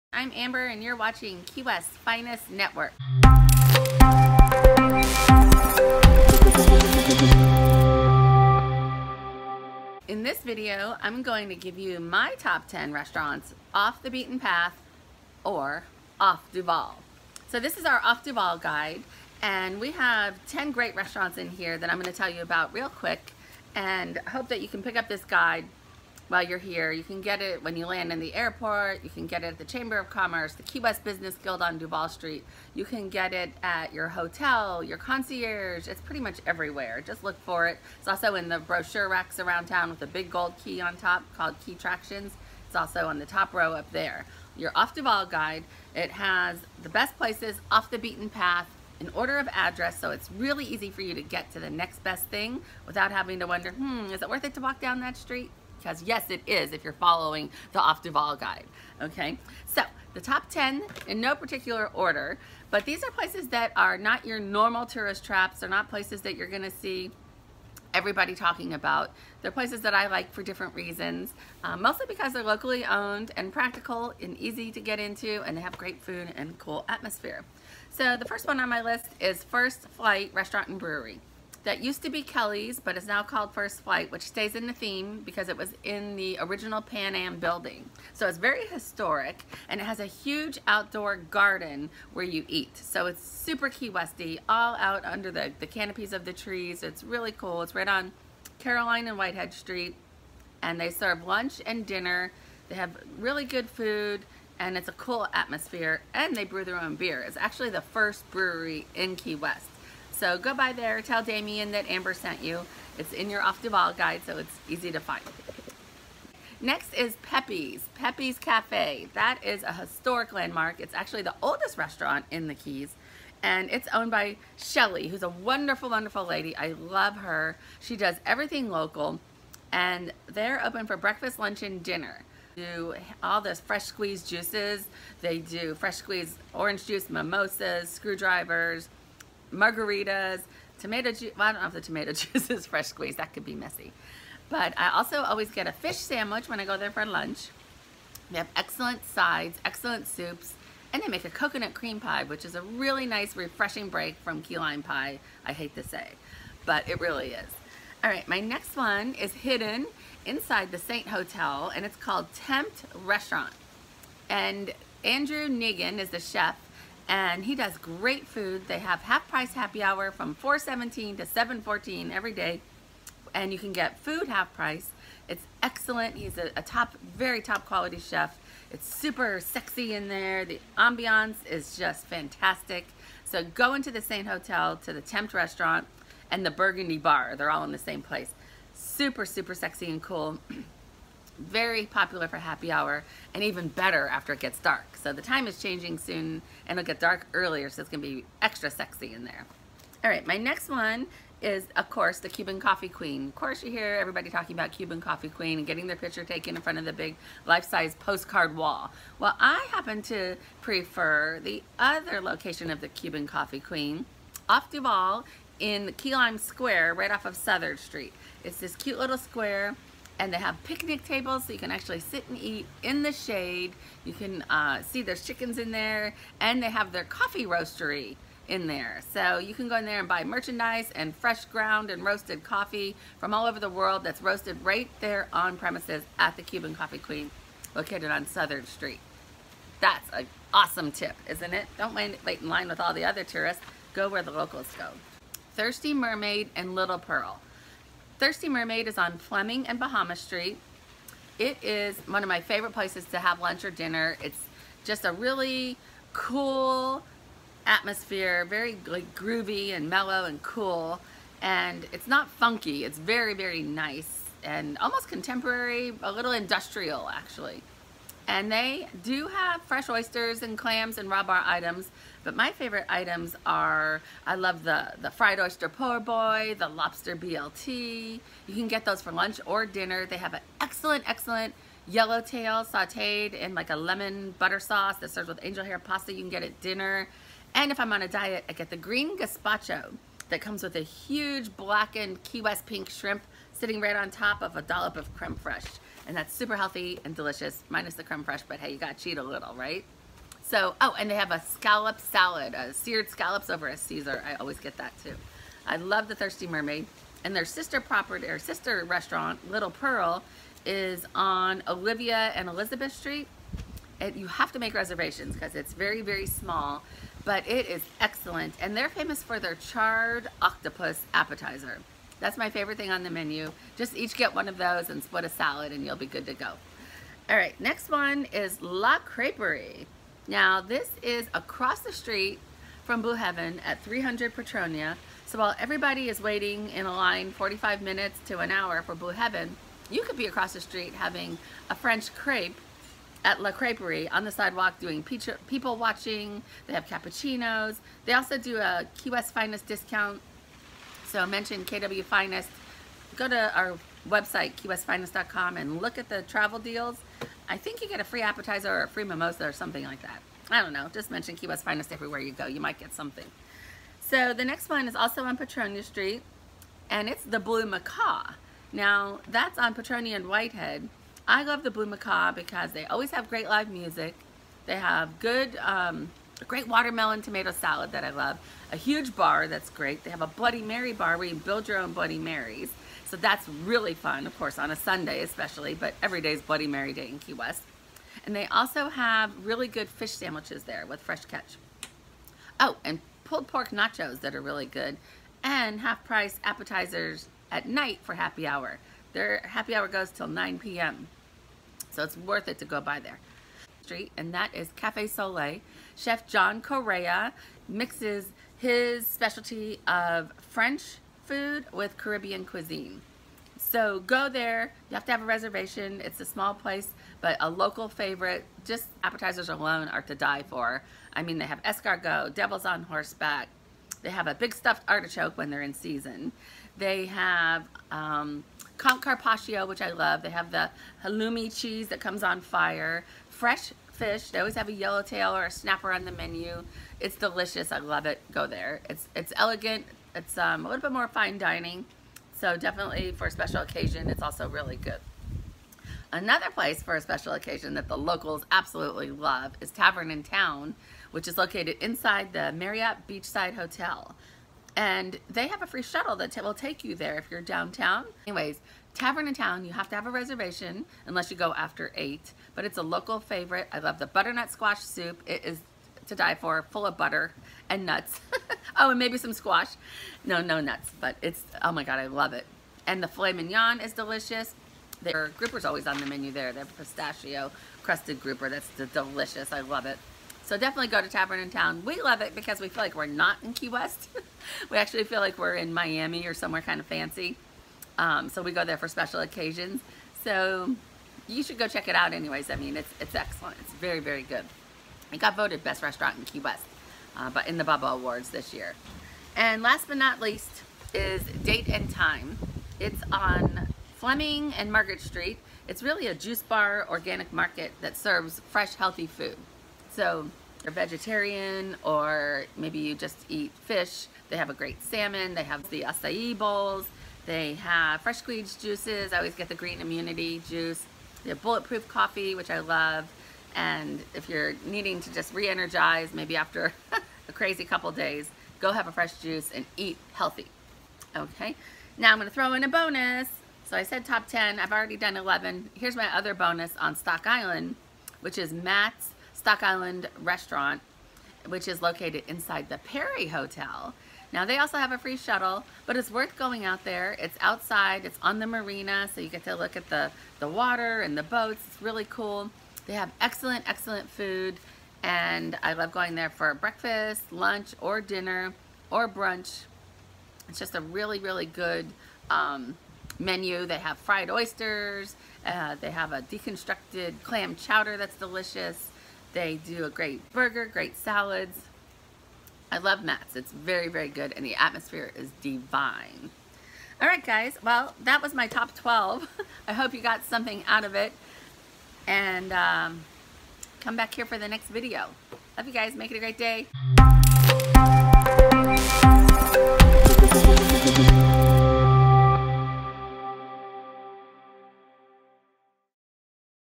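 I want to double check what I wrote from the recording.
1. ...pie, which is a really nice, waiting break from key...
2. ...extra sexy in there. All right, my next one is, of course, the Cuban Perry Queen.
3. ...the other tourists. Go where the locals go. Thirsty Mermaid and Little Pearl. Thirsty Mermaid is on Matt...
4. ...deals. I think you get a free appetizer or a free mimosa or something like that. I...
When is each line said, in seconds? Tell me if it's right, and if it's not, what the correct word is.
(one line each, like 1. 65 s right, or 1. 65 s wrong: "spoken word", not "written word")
1. 151 s wrong: "refreshing", not "waiting"
2. 198 s wrong: "Coffee", not "Perry"
3. 242 s wrong: "Fleming", not "Matt"
4. 356 s right.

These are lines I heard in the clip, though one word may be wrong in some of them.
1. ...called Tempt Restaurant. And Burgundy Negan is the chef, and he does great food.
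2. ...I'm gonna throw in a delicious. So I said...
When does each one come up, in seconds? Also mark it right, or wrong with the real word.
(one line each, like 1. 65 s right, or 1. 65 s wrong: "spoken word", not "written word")
1. 161 s wrong: "Andrew", not "Burgundy"
2. 532 s wrong: "bonus", not "delicious".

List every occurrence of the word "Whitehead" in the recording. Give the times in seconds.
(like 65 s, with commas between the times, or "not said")
99 s, 370 s.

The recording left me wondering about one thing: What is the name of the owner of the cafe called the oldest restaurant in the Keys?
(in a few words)
Shelly.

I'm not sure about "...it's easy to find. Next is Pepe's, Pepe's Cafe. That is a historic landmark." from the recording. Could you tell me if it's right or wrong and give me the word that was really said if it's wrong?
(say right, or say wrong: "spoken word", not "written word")
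right.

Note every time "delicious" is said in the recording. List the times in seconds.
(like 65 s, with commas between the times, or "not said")
297 s, 437 s, 473 s, 478 s, 568 s.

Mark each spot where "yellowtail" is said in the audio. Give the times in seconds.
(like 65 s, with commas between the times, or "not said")
281 s, 434 s.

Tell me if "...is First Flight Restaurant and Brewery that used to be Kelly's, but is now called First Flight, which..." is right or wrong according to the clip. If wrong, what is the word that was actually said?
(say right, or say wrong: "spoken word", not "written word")
right.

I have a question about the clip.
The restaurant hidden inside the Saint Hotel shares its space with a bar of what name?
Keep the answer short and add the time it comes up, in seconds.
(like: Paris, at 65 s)
Burgundy Bar, at 186 s.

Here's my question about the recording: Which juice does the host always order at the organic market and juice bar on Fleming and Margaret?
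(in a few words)
green immunity juice.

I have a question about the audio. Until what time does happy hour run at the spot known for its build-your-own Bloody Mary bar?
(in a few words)
9 p.m.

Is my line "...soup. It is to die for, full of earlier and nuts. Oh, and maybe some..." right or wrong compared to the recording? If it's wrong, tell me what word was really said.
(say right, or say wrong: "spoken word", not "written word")
wrong: "butter", not "earlier".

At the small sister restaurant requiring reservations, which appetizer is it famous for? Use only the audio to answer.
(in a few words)
charred octopus.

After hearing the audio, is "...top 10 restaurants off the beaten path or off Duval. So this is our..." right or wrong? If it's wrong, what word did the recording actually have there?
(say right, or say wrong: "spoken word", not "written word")
right.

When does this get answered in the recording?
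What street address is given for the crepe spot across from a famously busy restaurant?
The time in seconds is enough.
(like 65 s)
333 s.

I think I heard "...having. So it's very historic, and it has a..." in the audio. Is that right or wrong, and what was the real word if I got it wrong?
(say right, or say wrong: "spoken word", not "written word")
wrong: "building", not "having".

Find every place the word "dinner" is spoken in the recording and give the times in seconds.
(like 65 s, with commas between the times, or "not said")
101 s, 131 s, 253 s, 279 s, 286 s, 558 s.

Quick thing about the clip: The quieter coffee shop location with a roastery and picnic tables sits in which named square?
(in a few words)
Key Lime Square.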